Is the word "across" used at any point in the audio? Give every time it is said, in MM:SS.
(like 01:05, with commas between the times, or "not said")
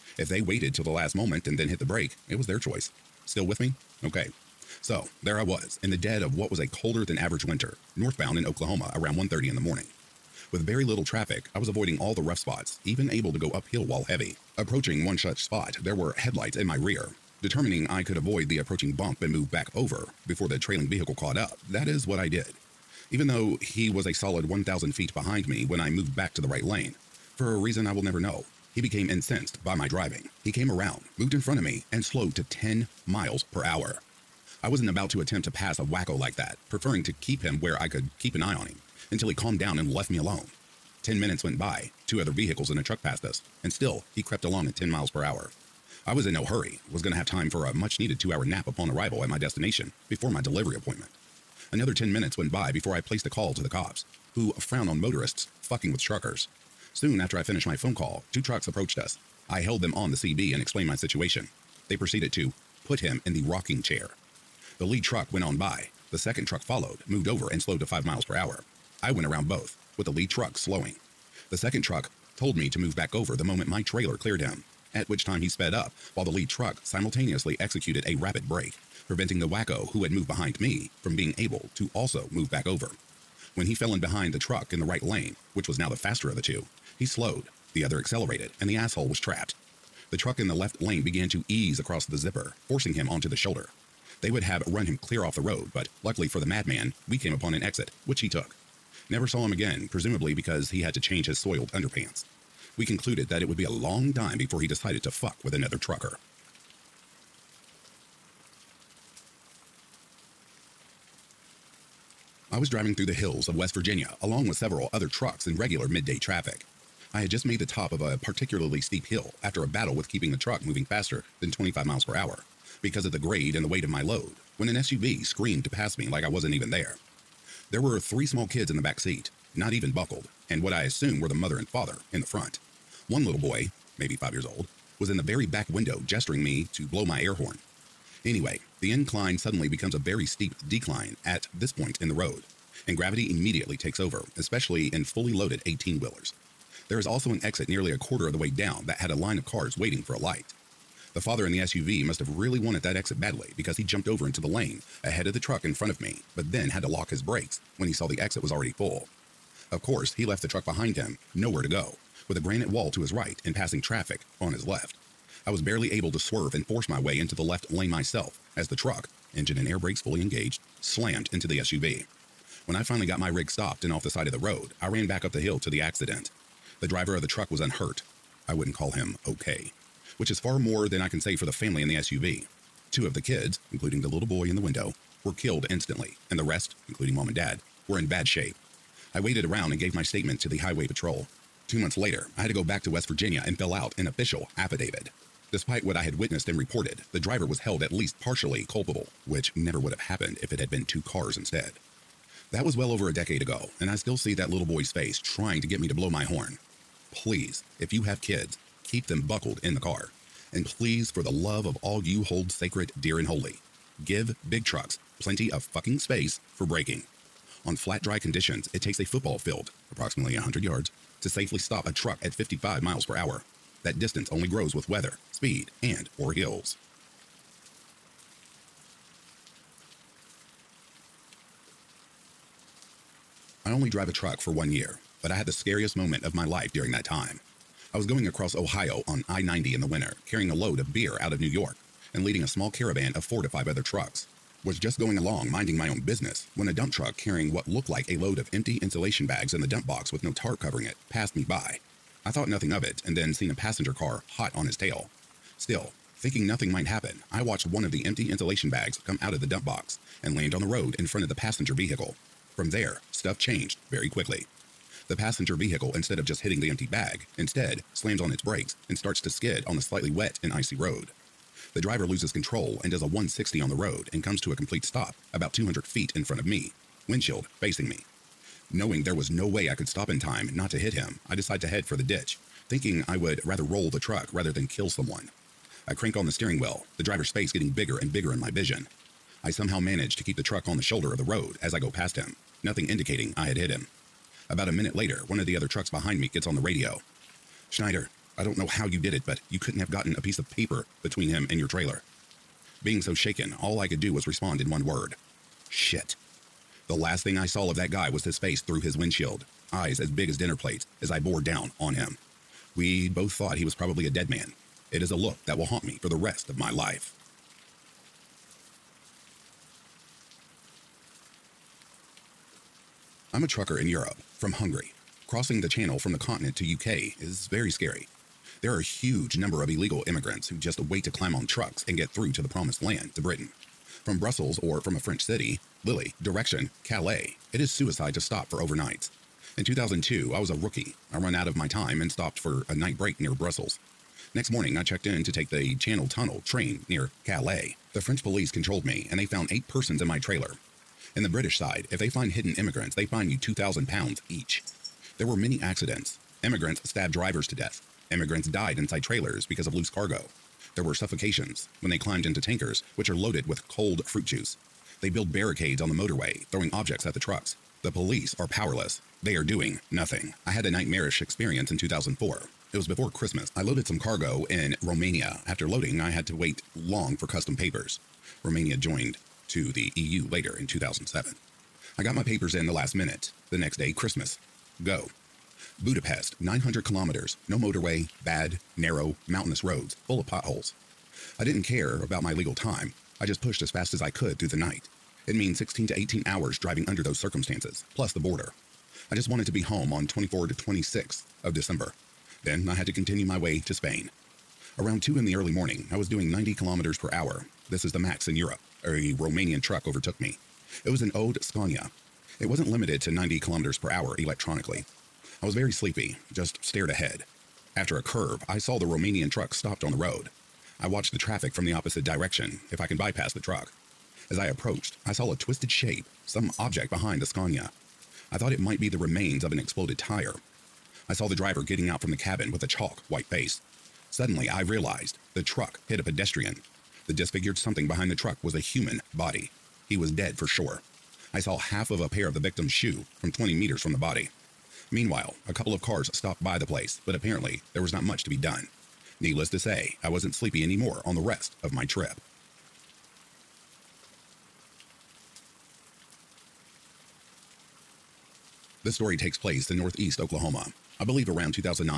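01:31, 03:58.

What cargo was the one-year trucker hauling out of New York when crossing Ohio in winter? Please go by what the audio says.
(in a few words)
Beer.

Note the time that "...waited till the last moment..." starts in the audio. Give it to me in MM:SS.
00:00.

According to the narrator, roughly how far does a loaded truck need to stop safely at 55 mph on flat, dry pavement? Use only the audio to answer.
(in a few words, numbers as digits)
100 yards.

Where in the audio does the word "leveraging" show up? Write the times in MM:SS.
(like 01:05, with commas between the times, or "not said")
not said.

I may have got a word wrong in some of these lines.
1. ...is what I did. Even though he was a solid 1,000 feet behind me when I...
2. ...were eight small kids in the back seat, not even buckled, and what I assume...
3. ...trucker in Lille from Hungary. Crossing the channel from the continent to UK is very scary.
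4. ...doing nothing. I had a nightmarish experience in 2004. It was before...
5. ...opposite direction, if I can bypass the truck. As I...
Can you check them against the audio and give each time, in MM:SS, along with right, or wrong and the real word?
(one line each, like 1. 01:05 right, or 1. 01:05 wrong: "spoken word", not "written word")
1. 00:21 right
2. 02:07 wrong: "three", not "eight"
3. 05:23 wrong: "Europe", not "Lille"
4. 06:09 right
5. 07:01 right.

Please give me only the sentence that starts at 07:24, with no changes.
Meanwhile, a couple of cars stopped by the place, but apparently there was not much to be done.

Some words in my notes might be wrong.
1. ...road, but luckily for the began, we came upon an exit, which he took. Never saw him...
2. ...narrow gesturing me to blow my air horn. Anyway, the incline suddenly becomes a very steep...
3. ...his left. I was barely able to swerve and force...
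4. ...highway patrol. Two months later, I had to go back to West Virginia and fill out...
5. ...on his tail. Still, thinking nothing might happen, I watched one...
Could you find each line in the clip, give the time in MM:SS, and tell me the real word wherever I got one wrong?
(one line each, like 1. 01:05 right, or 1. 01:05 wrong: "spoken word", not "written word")
1. 01:35 wrong: "madman", not "began"
2. 02:15 wrong: "window", not "narrow"
3. 02:44 right
4. 03:10 right
5. 04:14 right.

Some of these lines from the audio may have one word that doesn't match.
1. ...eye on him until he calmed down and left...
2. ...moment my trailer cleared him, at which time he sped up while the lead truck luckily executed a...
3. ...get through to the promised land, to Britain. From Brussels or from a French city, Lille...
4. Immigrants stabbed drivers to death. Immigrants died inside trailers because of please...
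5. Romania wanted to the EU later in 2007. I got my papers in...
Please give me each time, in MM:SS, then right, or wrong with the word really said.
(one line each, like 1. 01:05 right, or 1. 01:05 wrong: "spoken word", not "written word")
1. 00:38 right
2. 01:13 wrong: "simultaneously", not "luckily"
3. 05:31 right
4. 05:56 wrong: "loose", not "please"
5. 06:18 wrong: "joined", not "wanted".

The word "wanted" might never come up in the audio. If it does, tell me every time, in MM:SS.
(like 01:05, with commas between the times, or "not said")
02:32, 06:39.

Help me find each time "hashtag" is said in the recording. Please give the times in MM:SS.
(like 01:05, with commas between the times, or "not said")
not said.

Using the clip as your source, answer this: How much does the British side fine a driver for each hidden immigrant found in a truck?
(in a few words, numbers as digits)
2,000 pounds.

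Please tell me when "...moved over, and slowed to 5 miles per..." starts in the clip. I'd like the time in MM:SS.
01:07.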